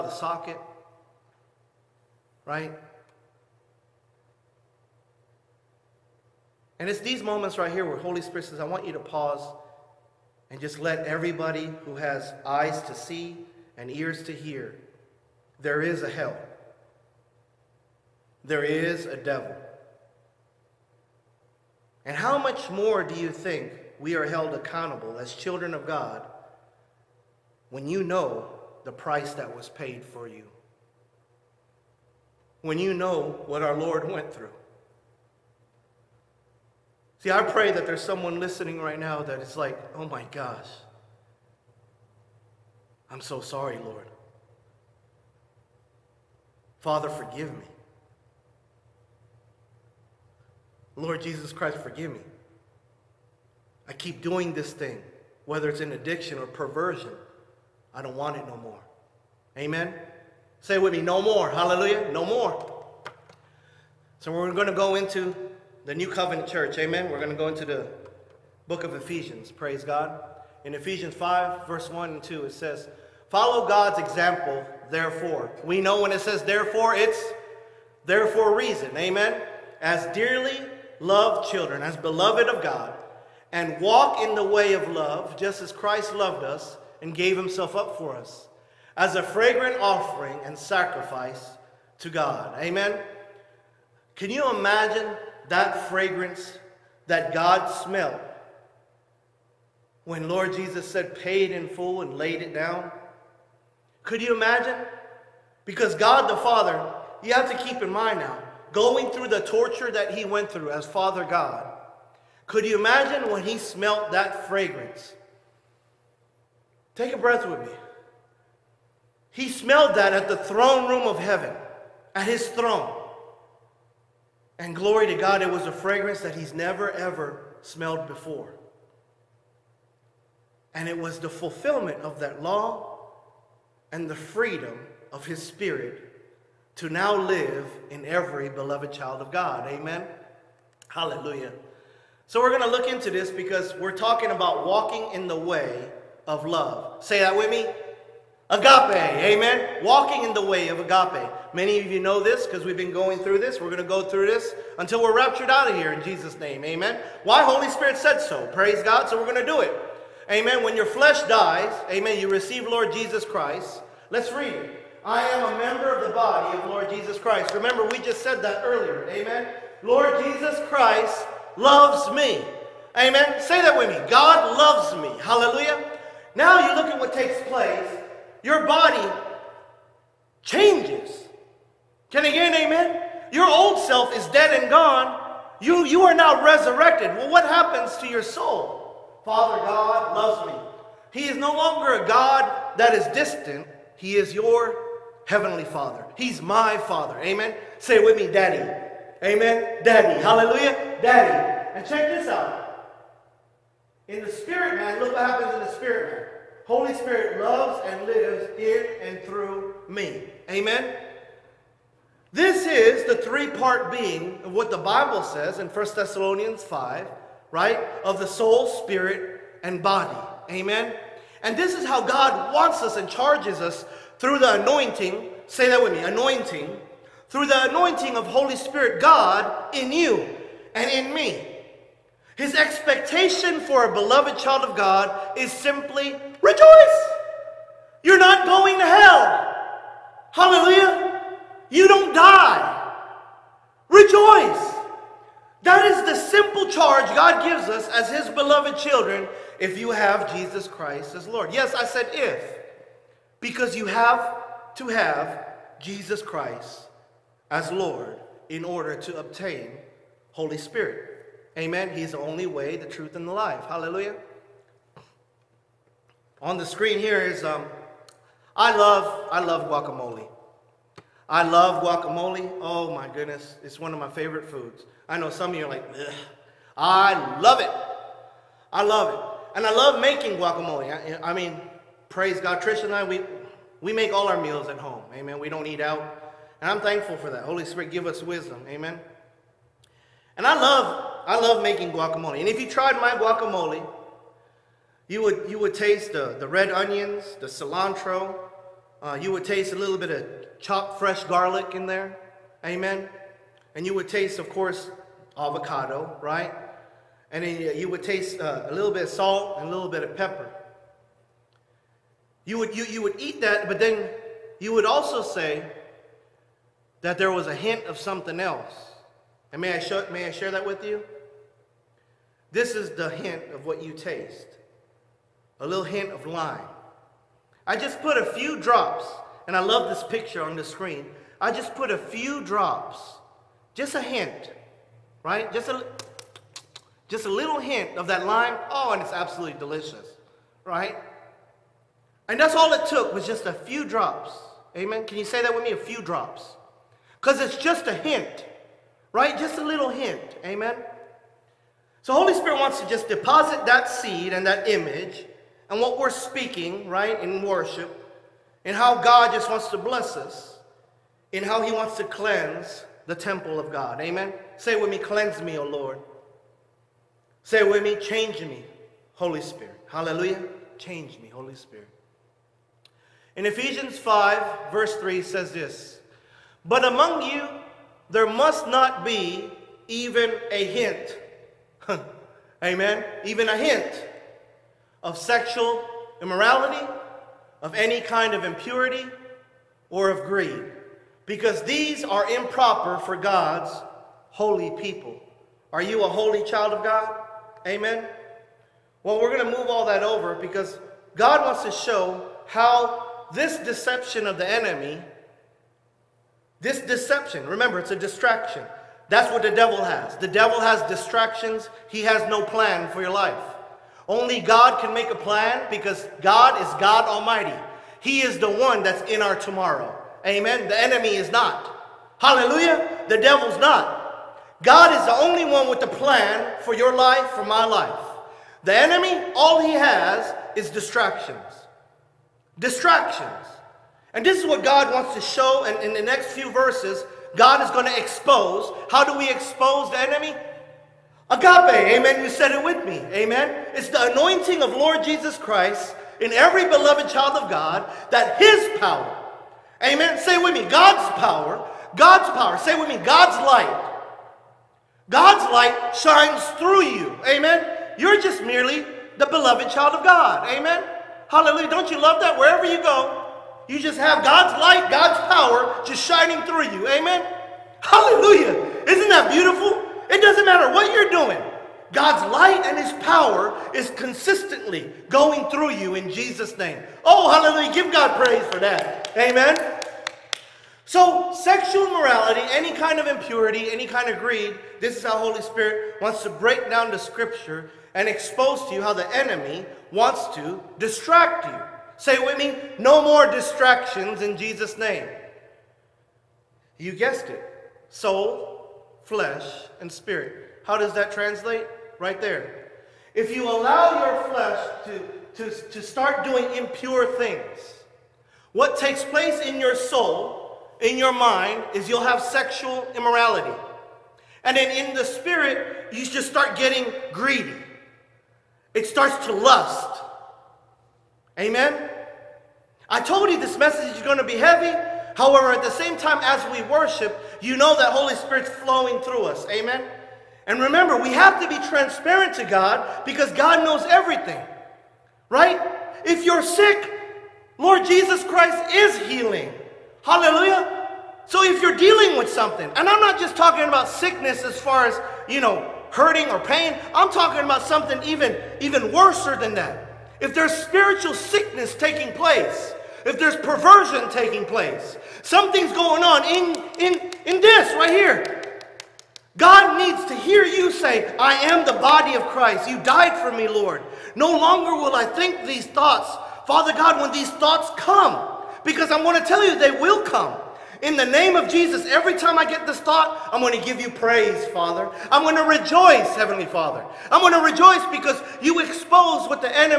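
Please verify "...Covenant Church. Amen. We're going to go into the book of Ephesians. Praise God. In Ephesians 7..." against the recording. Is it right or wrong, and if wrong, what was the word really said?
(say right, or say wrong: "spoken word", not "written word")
wrong: "5", not "7".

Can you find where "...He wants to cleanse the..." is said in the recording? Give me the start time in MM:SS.
06:01.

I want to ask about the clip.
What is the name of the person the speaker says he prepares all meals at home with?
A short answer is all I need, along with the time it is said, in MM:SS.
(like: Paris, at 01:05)
Trish, at 04:42.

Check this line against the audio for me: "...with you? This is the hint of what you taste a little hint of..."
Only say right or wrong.
right.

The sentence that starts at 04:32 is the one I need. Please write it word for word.
Oh my goodness, it's one of my favorite foods.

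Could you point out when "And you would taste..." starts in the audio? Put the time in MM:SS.
05:03.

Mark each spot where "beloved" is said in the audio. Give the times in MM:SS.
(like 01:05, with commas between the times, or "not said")
01:21, 02:18, 03:53, 04:08, 07:26, 07:39.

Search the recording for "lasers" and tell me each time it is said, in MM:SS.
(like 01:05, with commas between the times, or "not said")
not said.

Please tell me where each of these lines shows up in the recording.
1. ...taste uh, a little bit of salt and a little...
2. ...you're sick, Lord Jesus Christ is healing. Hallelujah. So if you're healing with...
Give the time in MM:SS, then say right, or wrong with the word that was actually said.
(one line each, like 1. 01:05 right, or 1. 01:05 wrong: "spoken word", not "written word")
1. 05:08 right
2. 08:56 wrong: "dealing", not "healing".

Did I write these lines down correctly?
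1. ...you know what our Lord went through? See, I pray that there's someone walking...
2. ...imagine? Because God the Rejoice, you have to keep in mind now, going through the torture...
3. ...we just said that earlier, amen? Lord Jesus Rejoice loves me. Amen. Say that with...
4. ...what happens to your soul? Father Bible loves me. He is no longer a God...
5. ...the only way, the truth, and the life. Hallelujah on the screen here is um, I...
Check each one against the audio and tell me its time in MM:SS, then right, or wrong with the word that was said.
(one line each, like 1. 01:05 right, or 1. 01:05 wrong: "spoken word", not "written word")
1. 00:32 wrong: "listening", not "walking"
2. 01:44 wrong: "Father", not "Rejoice"
3. 02:47 wrong: "Christ", not "Rejoice"
4. 03:07 wrong: "God", not "Bible"
5. 04:22 right.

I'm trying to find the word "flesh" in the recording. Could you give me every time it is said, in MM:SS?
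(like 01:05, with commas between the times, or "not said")
02:40, 08:19, 08:24.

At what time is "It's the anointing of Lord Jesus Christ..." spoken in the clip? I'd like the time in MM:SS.
07:23.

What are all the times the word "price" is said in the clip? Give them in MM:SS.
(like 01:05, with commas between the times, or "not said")
00:28.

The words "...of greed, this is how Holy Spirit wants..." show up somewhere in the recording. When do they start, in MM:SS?
08:04.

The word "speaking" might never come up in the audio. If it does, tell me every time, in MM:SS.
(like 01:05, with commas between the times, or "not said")
05:56.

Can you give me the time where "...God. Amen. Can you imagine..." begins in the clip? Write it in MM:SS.
01:32.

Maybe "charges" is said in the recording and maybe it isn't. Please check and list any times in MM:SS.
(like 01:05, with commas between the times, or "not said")
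03:43, 04:06.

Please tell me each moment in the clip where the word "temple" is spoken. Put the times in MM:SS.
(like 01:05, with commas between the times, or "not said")
06:03.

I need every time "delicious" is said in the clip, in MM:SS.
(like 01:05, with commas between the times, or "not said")
05:39.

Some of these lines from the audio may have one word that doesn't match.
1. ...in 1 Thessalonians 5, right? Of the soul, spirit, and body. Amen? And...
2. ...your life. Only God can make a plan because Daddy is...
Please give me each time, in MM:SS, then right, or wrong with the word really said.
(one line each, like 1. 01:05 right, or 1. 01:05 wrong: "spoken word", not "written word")
1. 03:35 right
2. 06:53 wrong: "God", not "Daddy".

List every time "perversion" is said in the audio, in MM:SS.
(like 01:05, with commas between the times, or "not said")
00:56, 09:13.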